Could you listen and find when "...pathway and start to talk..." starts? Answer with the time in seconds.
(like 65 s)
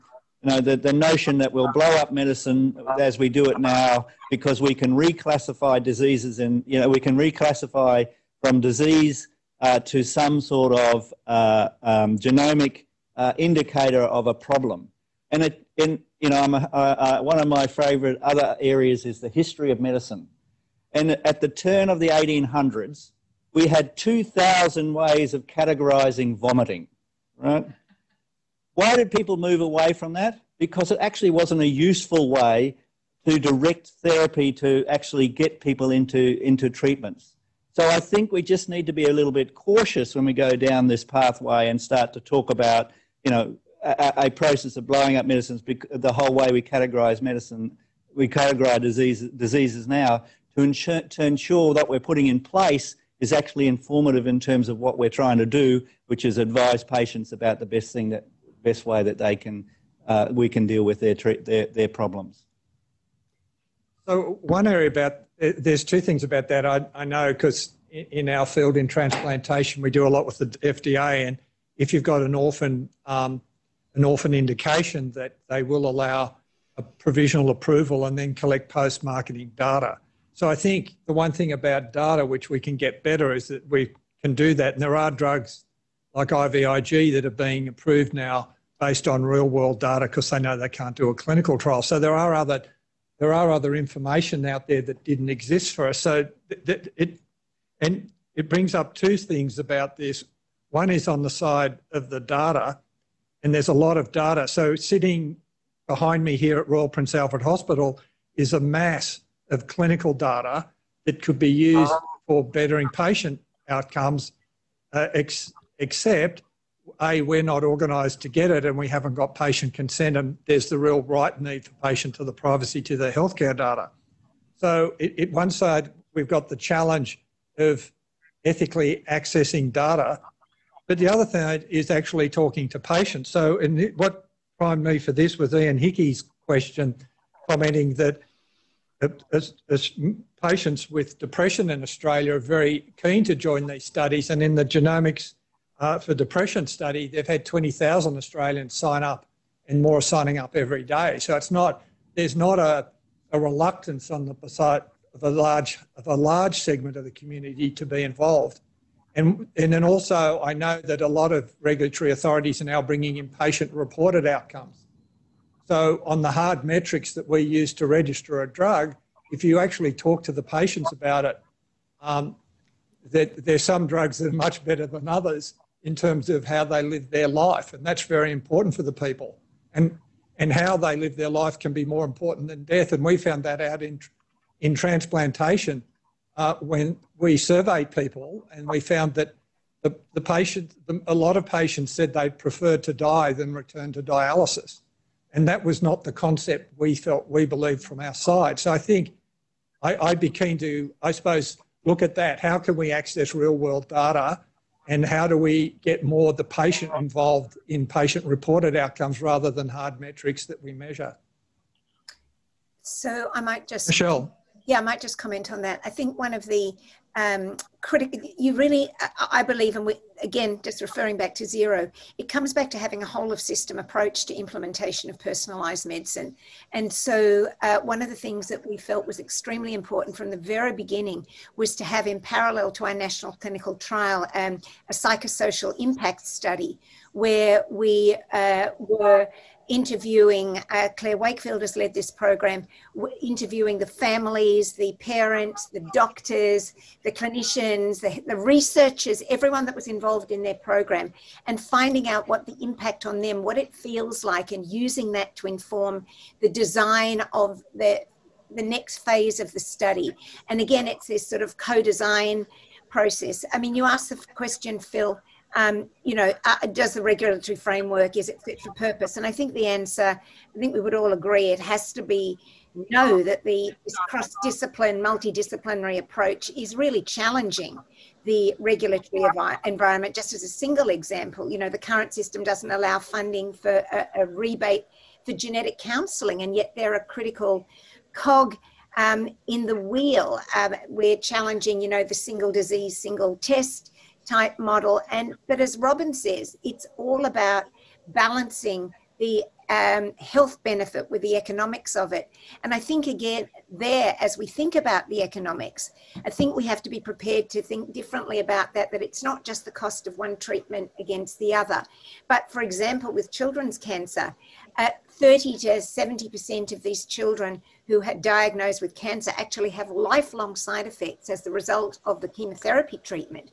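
41 s.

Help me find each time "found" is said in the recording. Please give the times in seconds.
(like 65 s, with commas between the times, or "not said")
183 s, 188 s.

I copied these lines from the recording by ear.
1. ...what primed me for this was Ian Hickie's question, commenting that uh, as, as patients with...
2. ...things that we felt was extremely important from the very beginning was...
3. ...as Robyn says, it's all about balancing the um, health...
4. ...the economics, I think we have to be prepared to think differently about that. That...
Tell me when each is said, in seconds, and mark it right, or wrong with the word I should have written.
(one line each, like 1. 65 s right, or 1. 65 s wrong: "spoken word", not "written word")
1. 133 s right
2. 228 s right
3. 295 s right
4. 305 s right.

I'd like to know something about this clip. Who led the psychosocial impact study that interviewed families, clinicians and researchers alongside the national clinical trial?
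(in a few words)
Claire Wakefield.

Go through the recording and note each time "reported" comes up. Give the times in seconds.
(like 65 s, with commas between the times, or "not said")
163 s, 208 s.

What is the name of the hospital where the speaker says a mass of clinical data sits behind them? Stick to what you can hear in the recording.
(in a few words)
Royal Prince Alfred Hospital.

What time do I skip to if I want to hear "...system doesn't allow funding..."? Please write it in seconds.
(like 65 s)
282 s.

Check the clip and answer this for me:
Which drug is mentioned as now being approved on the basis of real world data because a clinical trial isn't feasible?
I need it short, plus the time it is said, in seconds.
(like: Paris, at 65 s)
IVIG, at 86 s.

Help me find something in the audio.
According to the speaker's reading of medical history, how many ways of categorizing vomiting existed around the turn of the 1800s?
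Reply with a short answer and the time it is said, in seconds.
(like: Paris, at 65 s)
2,000, at 23 s.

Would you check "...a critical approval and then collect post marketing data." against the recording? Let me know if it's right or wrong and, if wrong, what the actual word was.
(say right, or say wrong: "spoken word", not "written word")
wrong: "provisional", not "critical".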